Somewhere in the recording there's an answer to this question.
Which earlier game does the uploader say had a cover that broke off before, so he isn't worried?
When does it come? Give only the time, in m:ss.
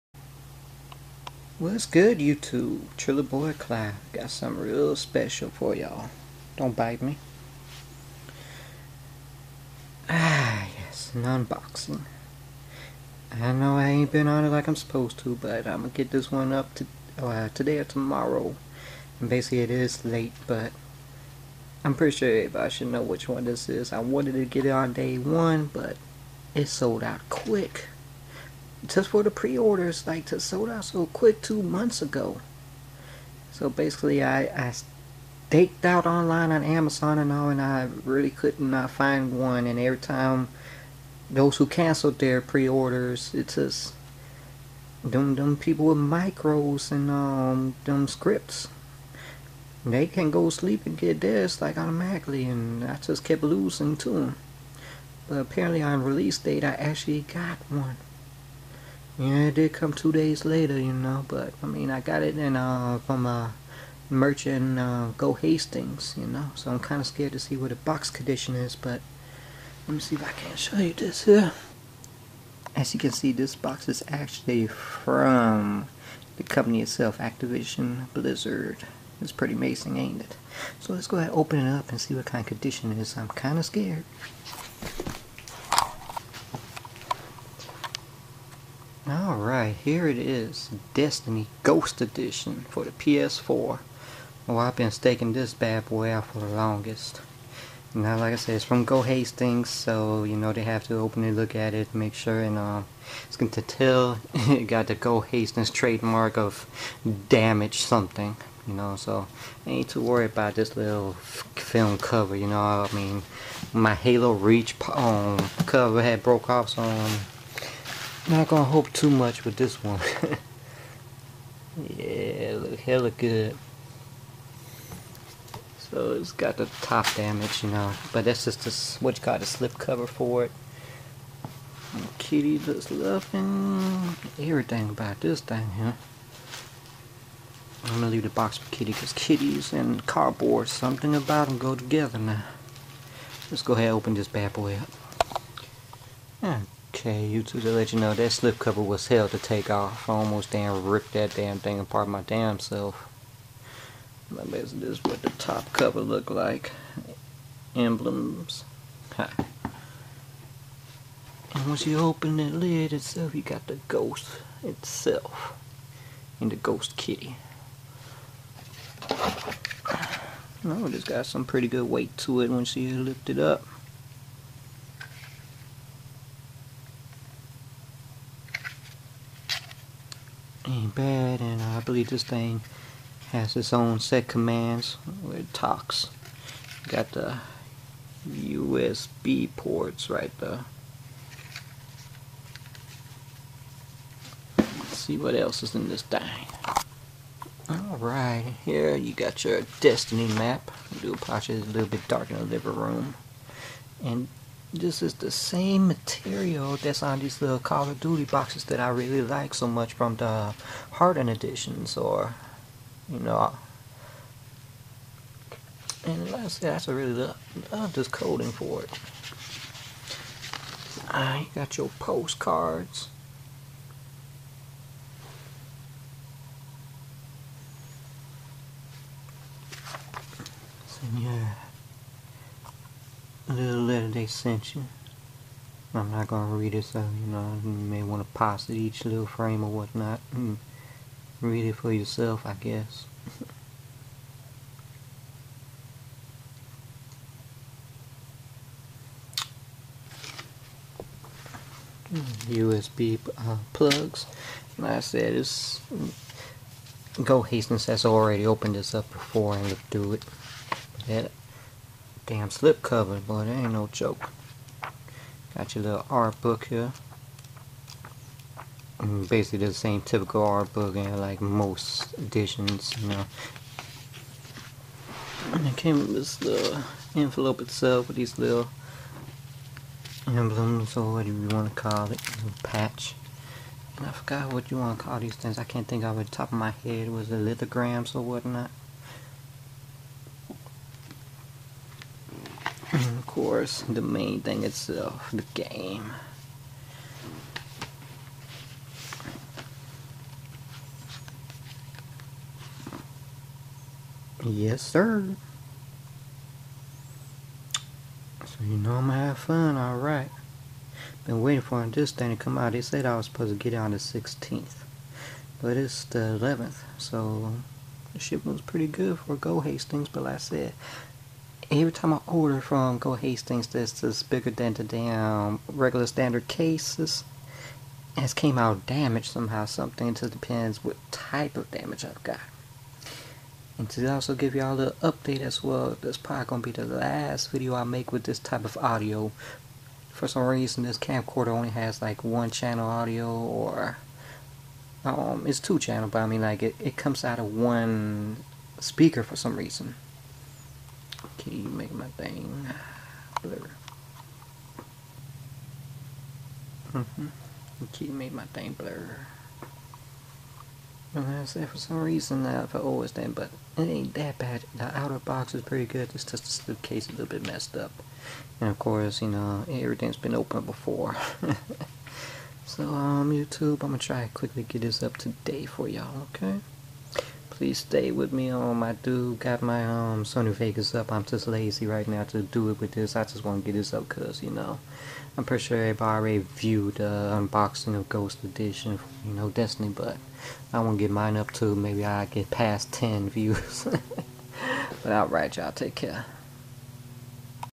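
1:53.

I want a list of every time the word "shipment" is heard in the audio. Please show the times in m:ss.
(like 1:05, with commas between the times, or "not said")
5:18.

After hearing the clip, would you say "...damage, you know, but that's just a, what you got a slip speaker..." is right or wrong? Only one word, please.
wrong.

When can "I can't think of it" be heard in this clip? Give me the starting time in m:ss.
4:45.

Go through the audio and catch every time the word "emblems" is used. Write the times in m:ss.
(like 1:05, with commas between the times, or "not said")
2:37, 4:40.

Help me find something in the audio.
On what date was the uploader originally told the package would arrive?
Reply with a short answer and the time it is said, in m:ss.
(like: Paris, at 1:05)
16th, at 5:13.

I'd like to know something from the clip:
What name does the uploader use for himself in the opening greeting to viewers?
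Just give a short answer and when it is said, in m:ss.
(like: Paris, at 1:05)
Trilla Boy Cloud, at 0:02.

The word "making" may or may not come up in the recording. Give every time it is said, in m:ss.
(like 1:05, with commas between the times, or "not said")
5:51, 5:58.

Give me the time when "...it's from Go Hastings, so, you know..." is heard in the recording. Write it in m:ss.
1:38.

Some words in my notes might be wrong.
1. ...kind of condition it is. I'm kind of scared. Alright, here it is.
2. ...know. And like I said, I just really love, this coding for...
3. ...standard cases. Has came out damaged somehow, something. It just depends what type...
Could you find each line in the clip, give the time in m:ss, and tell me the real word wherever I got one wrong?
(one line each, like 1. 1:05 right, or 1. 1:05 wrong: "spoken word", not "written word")
1. 1:22 right
2. 3:33 right
3. 5:26 right.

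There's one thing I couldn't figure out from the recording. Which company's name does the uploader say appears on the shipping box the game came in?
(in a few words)
Activision Blizzard.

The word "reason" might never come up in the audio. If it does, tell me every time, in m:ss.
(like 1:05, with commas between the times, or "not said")
5:40, 5:49, 6:02.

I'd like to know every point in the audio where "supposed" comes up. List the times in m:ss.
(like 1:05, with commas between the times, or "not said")
0:14, 5:13.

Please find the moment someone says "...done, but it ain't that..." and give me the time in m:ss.
6:03.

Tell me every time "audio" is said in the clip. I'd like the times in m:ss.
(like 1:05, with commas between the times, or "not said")
5:38, 5:42.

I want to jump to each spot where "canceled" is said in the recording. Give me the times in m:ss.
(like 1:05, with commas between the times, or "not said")
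0:41.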